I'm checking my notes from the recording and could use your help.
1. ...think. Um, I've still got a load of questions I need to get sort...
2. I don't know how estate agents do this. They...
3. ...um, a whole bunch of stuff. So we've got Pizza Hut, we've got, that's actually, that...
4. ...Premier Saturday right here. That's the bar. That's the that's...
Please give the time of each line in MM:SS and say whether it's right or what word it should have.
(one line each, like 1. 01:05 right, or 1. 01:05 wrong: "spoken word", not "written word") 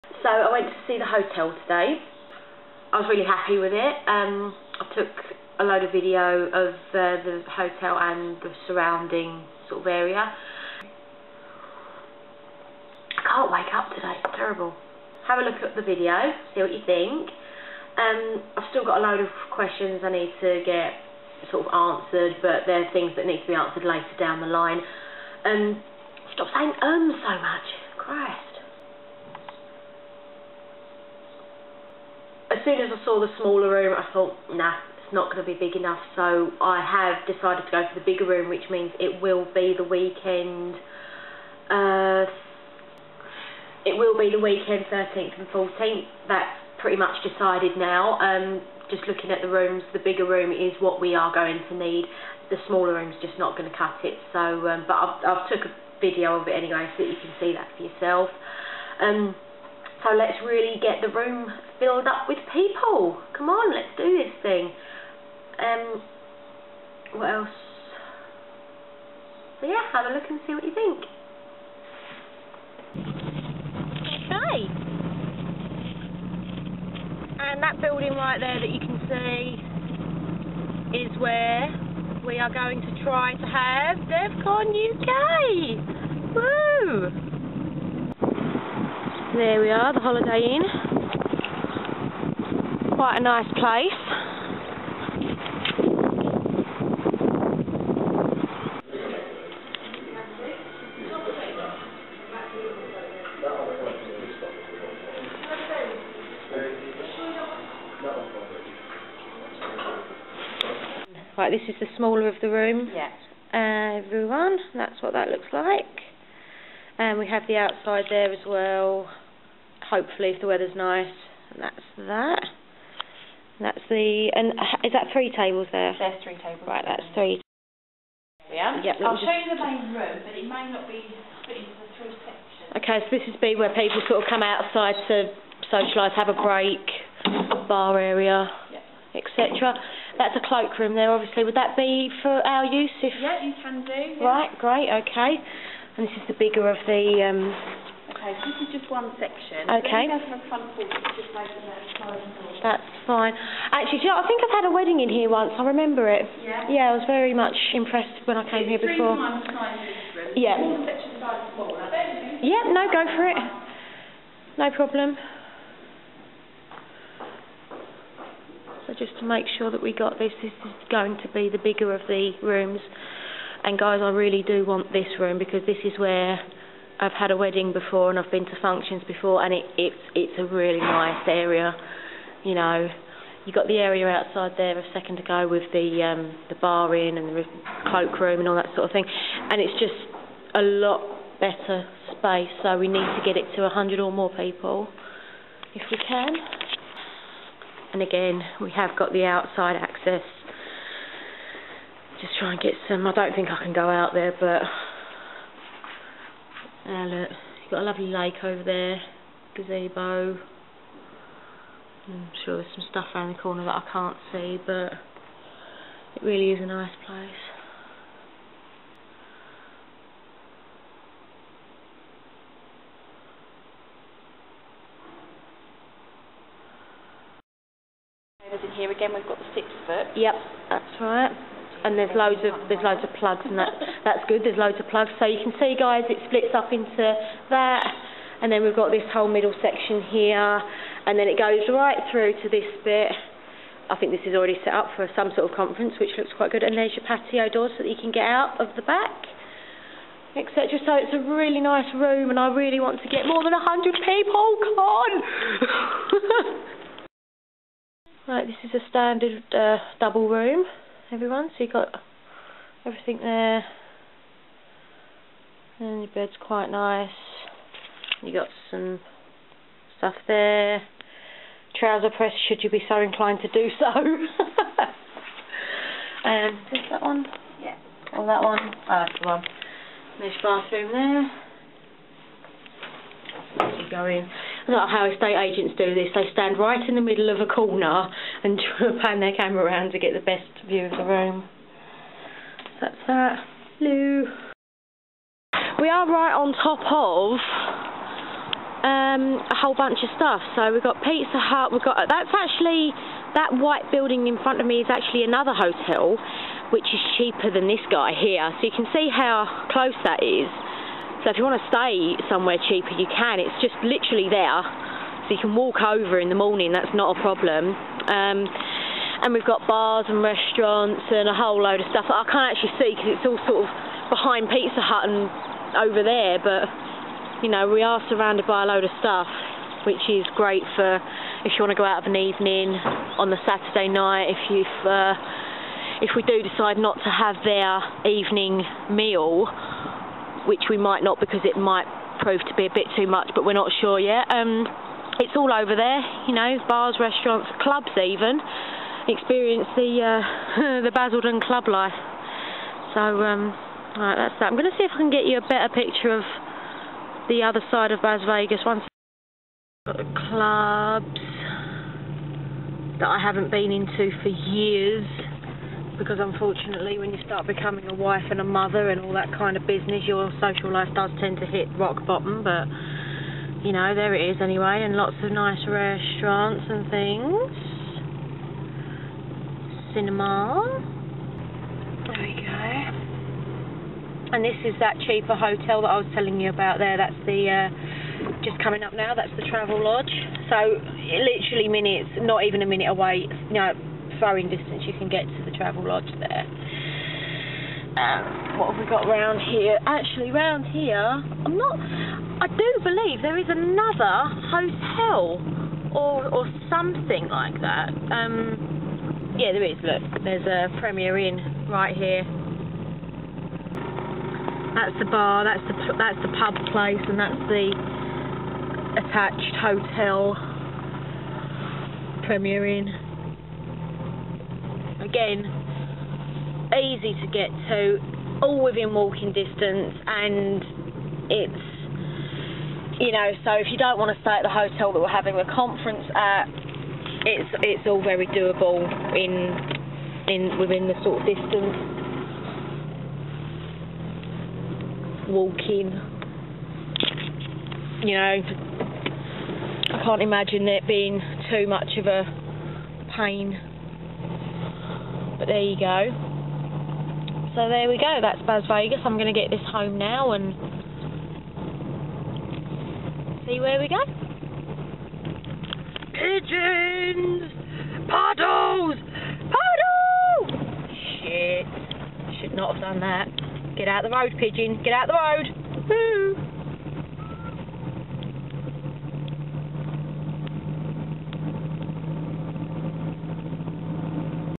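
1. 00:16 right
2. 04:44 right
3. 04:58 right
4. 06:50 wrong: "Inn", not "Saturday".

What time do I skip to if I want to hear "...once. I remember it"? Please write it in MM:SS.
02:35.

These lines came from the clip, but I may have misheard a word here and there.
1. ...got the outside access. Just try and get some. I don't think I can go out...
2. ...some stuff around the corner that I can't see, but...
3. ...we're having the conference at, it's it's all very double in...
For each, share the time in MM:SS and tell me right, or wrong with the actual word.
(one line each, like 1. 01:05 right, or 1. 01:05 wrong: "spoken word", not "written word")
1. 03:18 right
2. 03:32 right
3. 07:14 wrong: "doable", not "double".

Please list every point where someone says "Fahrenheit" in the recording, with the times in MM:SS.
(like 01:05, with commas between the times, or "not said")
not said.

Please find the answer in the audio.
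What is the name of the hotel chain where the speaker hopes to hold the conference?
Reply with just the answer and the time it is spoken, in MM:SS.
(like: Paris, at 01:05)
Holiday Inn, at 01:29.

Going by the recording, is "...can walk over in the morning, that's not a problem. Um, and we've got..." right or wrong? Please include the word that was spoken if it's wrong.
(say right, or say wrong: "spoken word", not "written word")
right.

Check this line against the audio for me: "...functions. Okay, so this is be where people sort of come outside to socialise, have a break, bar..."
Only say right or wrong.
wrong.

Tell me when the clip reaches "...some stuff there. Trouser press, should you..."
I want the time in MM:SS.
04:28.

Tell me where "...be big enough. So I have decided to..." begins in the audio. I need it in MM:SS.
00:35.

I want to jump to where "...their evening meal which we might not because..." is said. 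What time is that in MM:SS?
05:37.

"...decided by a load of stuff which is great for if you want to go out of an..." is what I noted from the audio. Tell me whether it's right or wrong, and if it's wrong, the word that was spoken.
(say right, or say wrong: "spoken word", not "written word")
wrong: "surrounded", not "decided".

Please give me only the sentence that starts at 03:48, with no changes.
Over here again, we've got the six foot.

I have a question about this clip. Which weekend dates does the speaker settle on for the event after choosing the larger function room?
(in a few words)
13th and 14th.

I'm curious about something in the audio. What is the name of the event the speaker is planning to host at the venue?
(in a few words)
DevCon UK.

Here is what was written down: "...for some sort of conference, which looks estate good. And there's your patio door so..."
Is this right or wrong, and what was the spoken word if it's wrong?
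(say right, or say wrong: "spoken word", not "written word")
wrong: "quite", not "estate".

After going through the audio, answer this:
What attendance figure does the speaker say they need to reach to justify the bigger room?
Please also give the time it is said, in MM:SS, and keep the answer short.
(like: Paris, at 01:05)
100, at 03:13.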